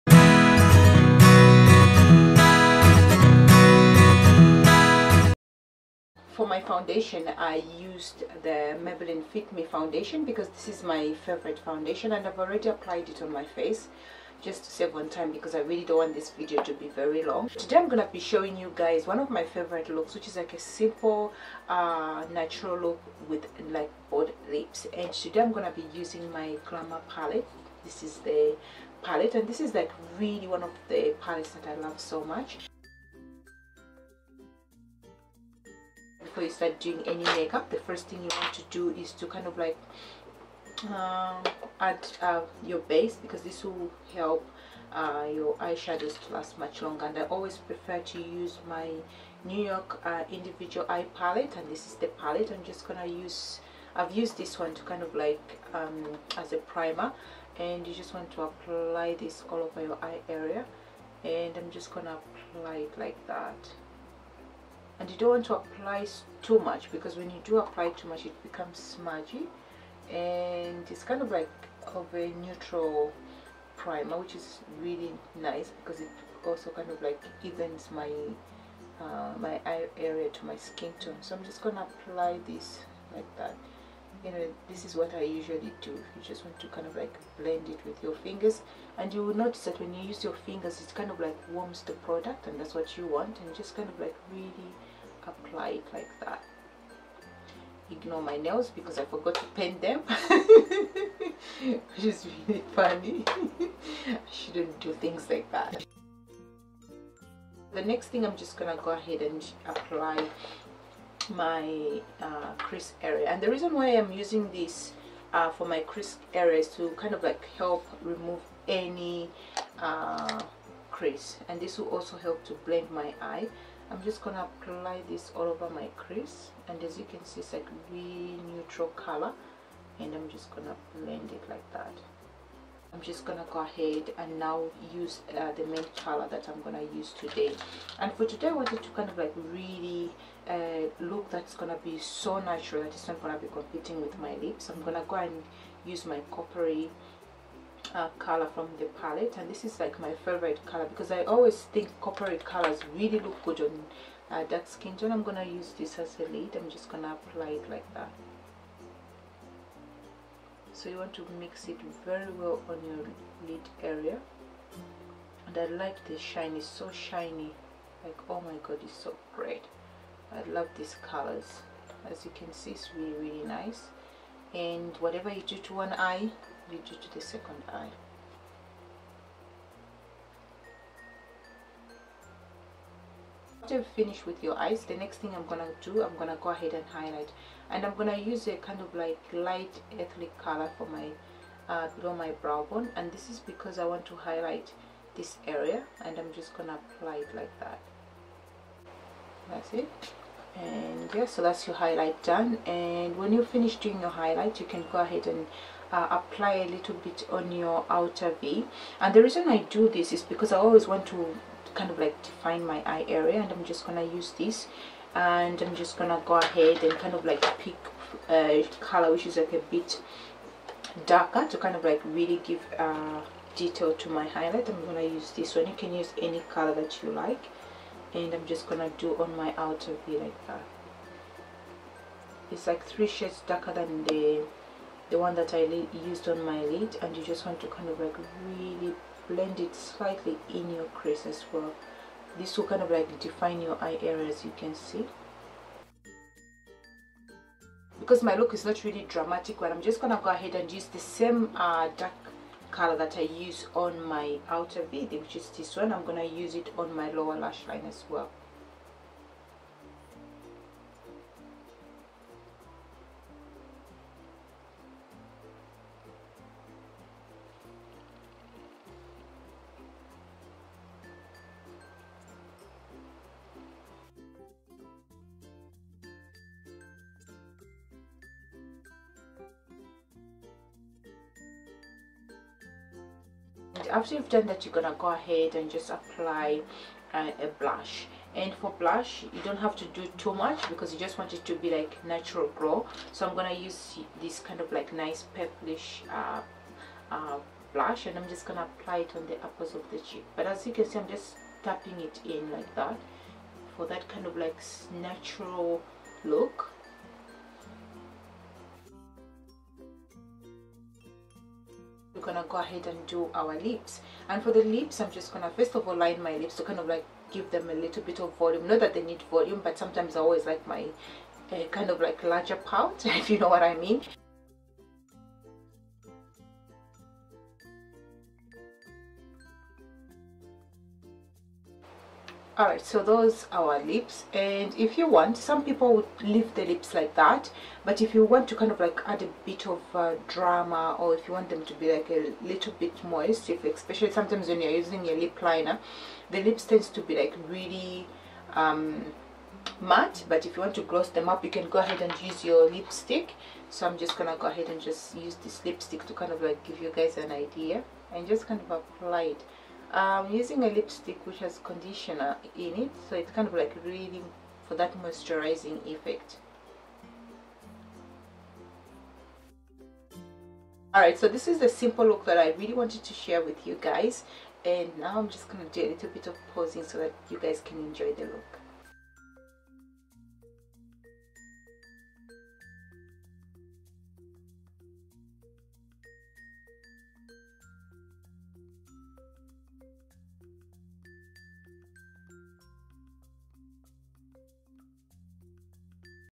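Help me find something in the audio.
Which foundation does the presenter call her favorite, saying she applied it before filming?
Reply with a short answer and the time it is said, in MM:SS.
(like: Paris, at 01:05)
Maybelline Fit Me, at 00:08.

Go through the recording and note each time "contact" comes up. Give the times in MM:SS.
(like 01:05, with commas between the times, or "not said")
not said.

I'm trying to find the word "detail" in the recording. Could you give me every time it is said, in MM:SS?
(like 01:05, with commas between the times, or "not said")
03:43.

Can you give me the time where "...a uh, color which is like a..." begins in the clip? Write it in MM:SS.
03:38.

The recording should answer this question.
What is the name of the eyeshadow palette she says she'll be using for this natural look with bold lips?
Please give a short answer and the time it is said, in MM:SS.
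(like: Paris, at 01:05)
Glamour palette, at 00:26.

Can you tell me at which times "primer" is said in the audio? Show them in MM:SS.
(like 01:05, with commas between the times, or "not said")
00:56, 01:13.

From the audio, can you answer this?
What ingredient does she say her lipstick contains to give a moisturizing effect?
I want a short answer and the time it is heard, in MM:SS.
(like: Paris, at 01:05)
conditioner, at 06:01.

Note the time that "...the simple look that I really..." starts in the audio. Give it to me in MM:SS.
06:11.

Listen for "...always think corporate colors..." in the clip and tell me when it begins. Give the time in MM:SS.
02:31.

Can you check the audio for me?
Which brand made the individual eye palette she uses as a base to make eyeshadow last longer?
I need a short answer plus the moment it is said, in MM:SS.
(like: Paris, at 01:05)
New York, at 00:49.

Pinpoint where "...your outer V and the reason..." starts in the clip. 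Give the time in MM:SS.
03:27.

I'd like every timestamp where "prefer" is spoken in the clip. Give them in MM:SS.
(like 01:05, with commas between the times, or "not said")
00:47.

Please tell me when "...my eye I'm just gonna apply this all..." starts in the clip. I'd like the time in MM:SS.
02:02.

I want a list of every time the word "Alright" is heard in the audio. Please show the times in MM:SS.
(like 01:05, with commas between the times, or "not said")
05:32, 06:10.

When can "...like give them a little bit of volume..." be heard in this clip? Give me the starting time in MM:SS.
05:16.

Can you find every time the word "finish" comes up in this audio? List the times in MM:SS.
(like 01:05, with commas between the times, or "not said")
03:03, 03:23.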